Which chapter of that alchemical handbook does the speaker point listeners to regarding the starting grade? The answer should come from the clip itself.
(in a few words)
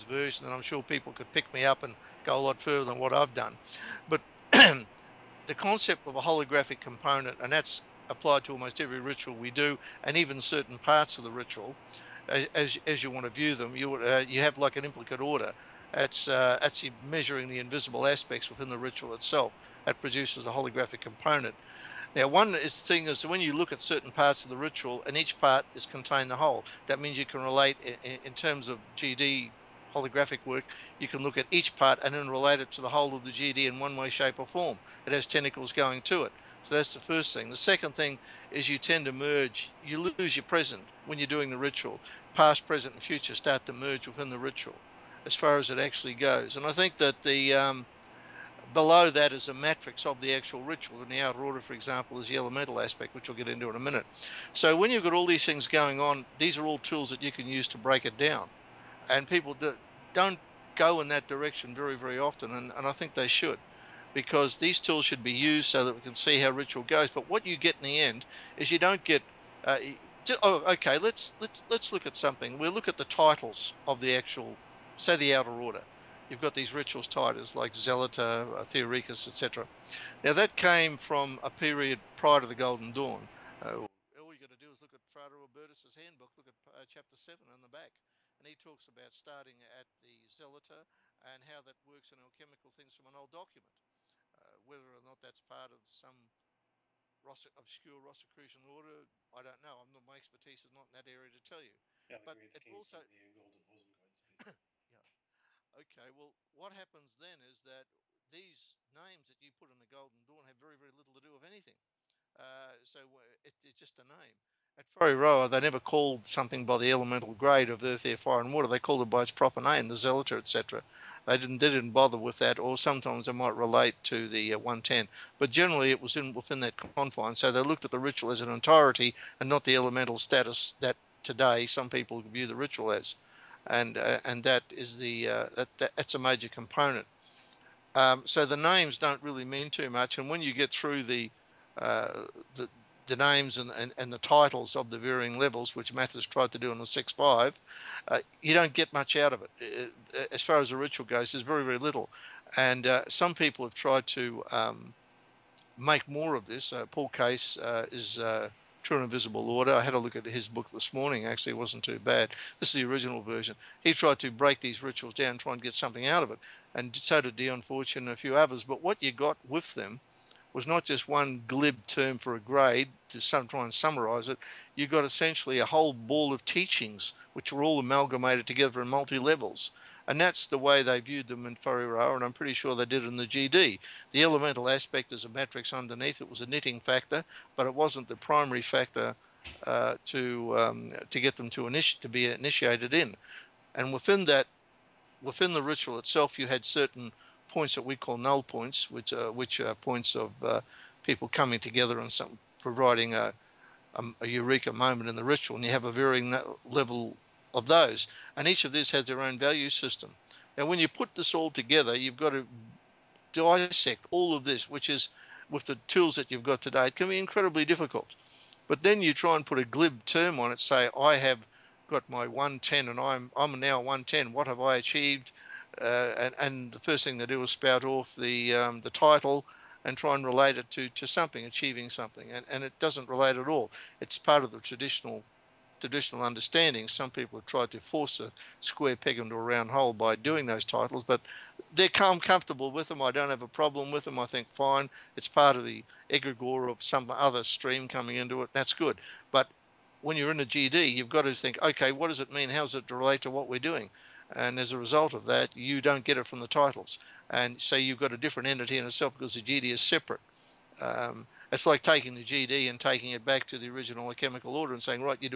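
7.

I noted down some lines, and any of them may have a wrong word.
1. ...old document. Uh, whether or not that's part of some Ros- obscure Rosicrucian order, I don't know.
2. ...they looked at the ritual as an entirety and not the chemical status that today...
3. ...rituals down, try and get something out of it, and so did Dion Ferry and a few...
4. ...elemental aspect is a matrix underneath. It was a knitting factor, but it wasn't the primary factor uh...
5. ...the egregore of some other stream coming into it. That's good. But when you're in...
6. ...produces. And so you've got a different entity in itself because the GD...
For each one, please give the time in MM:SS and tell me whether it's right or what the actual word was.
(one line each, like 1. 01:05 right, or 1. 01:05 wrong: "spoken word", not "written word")
1. 01:33 right
2. 02:07 wrong: "elemental", not "chemical"
3. 02:44 wrong: "Fortune", not "Ferry"
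4. 03:04 right
5. 04:05 right
6. 04:16 wrong: "titles", not "produces".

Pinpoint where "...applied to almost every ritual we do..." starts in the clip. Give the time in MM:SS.
00:08.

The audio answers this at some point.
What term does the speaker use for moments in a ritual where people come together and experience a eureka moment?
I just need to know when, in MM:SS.
03:18.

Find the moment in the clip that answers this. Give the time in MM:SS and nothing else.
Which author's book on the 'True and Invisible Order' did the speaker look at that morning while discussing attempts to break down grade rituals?
02:36.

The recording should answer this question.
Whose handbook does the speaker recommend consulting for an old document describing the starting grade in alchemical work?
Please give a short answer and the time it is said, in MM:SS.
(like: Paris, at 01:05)
Frater Albertus, at 01:25.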